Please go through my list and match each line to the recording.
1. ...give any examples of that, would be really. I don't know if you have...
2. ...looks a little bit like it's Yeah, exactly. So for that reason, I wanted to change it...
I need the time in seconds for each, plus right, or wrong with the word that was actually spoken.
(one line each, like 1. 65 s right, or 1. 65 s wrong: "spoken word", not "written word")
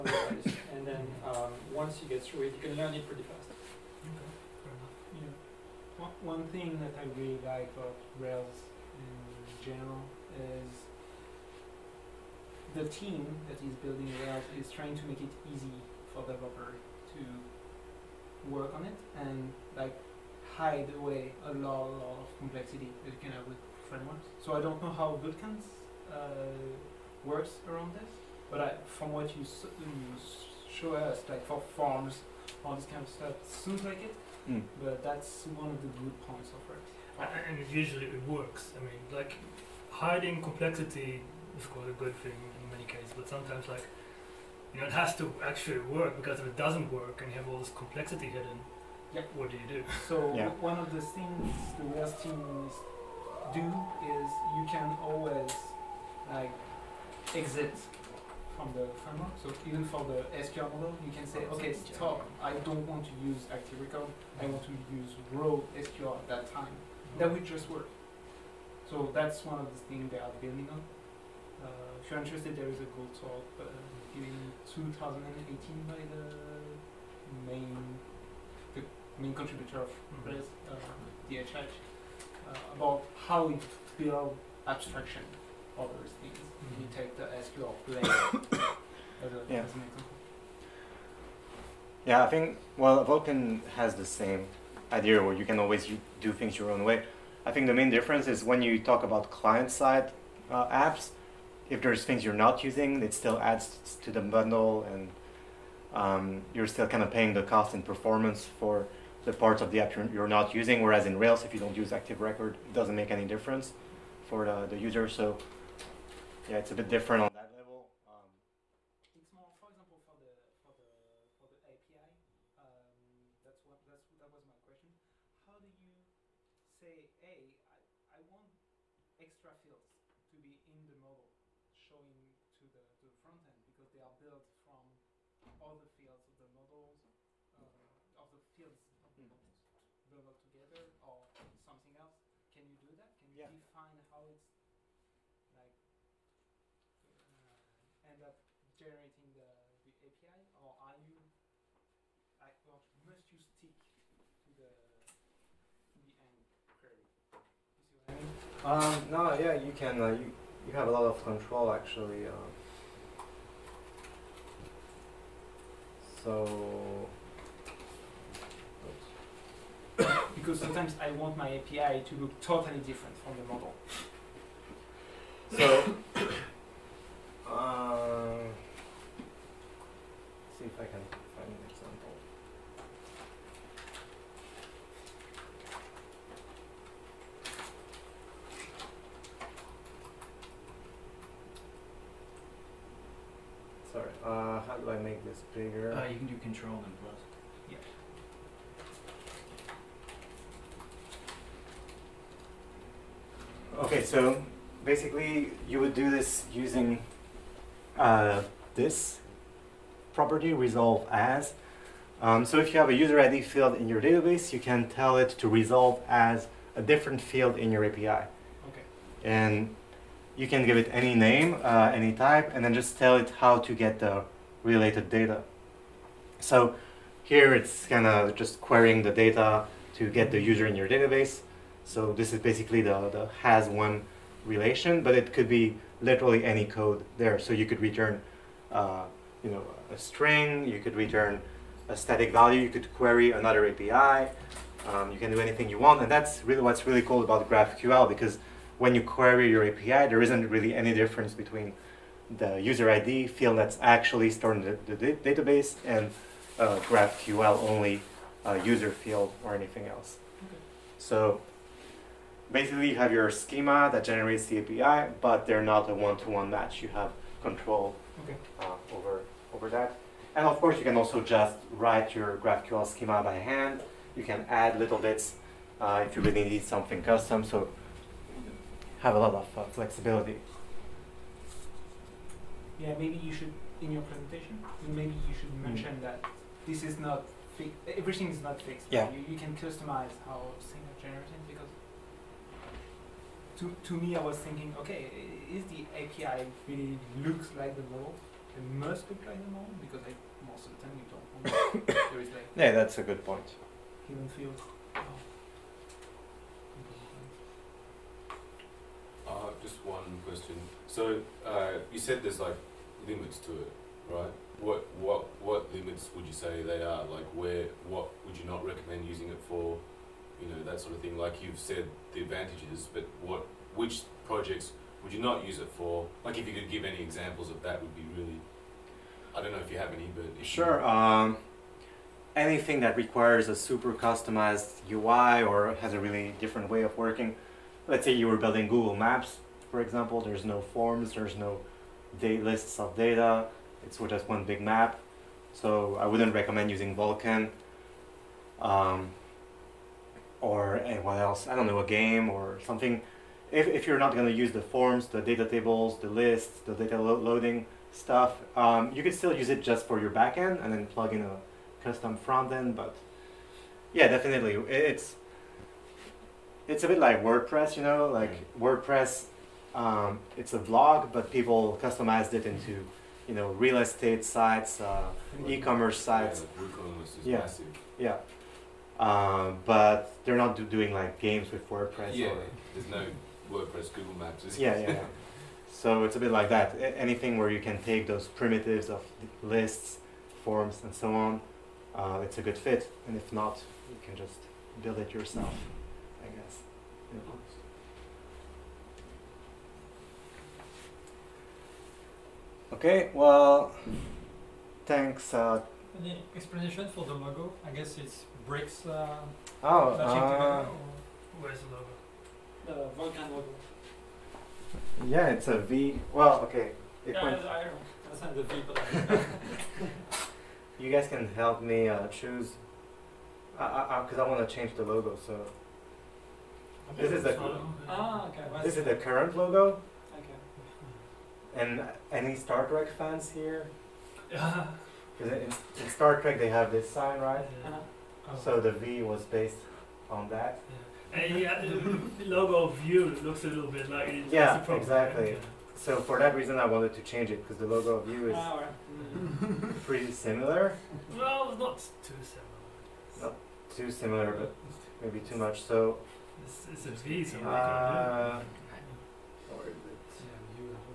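1. 326 s right
2. 443 s right.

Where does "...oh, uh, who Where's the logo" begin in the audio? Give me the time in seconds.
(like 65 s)
409 s.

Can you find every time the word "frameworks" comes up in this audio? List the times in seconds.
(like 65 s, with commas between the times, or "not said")
23 s, 59 s.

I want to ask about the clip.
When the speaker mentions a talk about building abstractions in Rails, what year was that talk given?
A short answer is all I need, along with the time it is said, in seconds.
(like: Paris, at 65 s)
2018, at 74 s.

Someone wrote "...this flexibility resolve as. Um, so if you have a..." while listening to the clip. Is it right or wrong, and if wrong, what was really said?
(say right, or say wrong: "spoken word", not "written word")
wrong: "property", not "flexibility".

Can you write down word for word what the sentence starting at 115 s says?
So yeah, it's a bit different on that level.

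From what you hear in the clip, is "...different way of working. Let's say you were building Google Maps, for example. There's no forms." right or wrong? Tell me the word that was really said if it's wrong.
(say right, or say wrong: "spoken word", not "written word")
right.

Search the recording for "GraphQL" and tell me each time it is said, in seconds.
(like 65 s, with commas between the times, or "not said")
247 s, 256 s, 272 s.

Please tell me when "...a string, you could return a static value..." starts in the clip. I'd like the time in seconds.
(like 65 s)
239 s.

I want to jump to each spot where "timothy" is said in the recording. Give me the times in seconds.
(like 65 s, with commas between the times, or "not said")
not said.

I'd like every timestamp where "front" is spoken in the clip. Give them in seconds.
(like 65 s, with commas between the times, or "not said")
133 s, 362 s.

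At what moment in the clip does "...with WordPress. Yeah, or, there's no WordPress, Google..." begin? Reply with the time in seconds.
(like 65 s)
381 s.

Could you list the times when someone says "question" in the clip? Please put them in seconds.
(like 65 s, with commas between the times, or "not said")
124 s, 310 s.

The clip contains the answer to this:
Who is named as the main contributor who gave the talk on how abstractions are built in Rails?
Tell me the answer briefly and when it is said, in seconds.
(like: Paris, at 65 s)
DHH, at 81 s.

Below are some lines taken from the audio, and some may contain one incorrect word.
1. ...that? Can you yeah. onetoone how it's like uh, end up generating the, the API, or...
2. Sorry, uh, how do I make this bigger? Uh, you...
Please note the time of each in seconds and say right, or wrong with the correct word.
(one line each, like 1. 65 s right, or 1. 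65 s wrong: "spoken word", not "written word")
1. 142 s wrong: "define", not "onetoone"
2. 193 s right.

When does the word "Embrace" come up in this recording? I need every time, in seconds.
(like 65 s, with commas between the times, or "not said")
80 s.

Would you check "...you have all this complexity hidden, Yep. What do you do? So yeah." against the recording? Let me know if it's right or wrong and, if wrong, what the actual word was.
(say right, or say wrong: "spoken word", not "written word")
right.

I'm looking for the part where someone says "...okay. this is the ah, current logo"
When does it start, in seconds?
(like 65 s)
427 s.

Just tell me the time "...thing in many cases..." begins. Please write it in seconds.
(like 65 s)
42 s.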